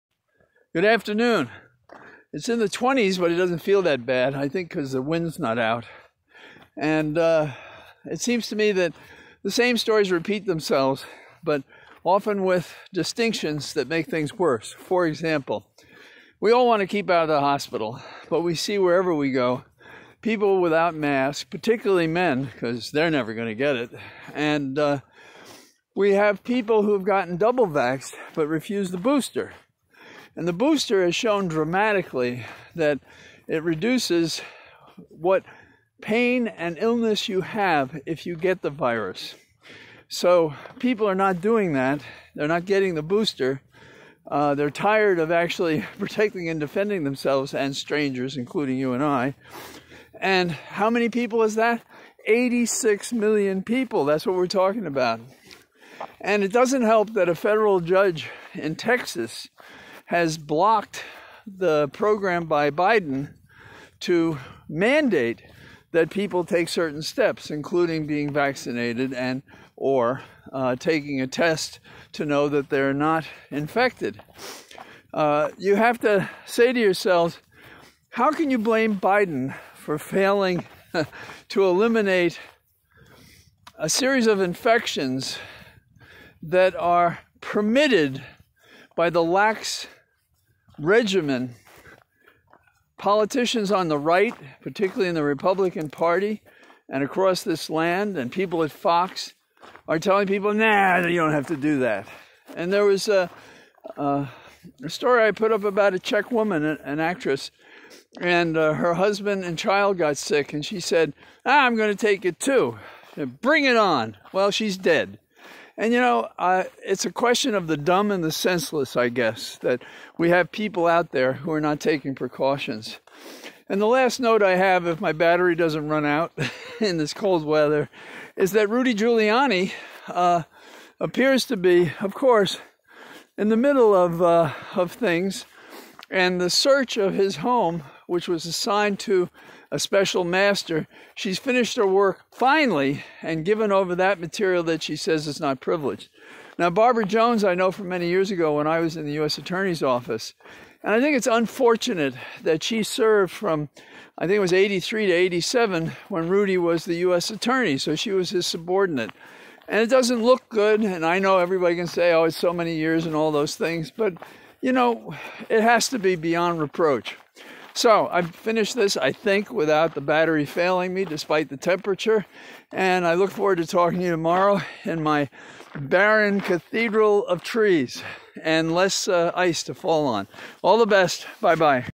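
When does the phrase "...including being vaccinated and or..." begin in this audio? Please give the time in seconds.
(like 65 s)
67 s.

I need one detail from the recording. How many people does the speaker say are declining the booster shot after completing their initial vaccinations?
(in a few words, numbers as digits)
86 million.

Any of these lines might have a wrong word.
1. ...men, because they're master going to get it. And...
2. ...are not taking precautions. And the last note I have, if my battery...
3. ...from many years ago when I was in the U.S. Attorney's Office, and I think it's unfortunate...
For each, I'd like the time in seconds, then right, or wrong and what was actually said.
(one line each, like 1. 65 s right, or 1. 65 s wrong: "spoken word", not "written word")
1. 22 s wrong: "never", not "master"
2. 121 s right
3. 147 s right.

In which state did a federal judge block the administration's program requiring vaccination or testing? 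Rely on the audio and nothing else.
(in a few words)
Texas.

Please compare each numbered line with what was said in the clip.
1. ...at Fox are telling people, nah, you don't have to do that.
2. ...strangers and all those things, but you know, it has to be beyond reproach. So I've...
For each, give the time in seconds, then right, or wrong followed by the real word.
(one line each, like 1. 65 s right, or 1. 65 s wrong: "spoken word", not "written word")
1. 98 s right
2. 162 s wrong: "years", not "strangers".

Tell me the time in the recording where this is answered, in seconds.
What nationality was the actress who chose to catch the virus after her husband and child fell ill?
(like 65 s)
105 s.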